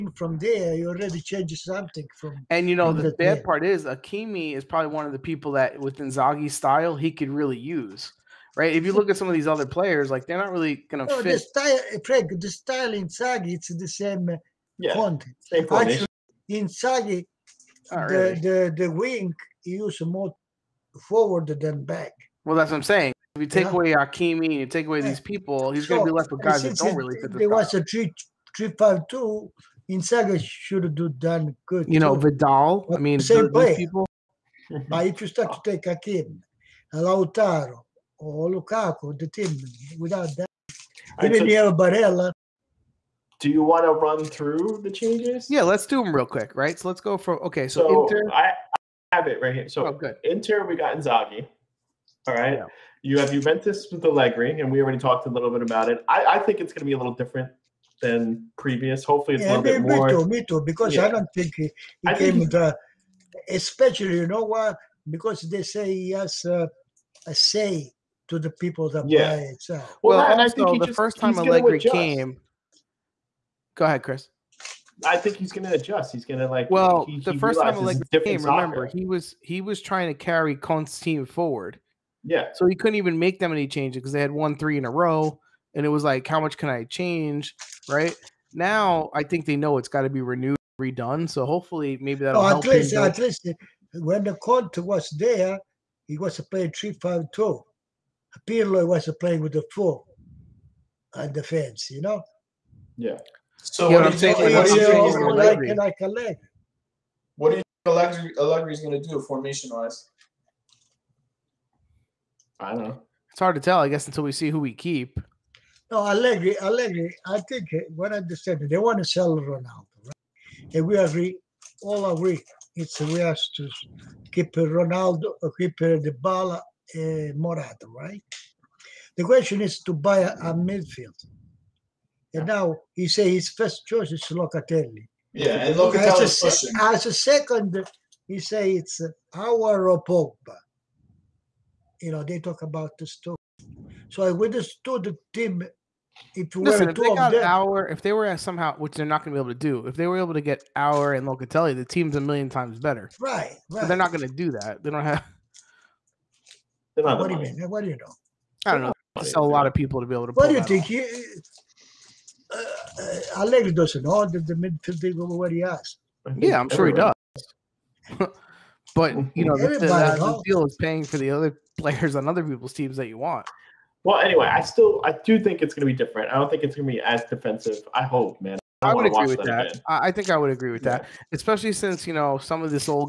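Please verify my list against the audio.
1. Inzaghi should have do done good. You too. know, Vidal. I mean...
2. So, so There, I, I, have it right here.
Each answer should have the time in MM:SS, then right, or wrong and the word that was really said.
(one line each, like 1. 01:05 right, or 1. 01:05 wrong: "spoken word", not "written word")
1. 00:29 right
2. 00:47 wrong: "Inter", not "There".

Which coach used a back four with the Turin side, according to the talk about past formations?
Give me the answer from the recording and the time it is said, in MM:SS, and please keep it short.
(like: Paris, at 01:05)
Pirlo, at 01:38.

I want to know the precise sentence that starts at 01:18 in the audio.
he was he was trying to carry Conte's team forward.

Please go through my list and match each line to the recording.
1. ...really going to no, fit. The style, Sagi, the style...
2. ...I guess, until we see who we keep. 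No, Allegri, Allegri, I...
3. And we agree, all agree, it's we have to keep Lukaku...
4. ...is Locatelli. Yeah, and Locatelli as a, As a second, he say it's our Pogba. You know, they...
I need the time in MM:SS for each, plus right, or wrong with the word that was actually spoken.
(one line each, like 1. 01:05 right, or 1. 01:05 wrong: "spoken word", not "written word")
1. 00:10 wrong: "Craig", not "Sagi"
2. 01:53 right
3. 02:00 wrong: "Ronaldo", not "Lukaku"
4. 02:14 right.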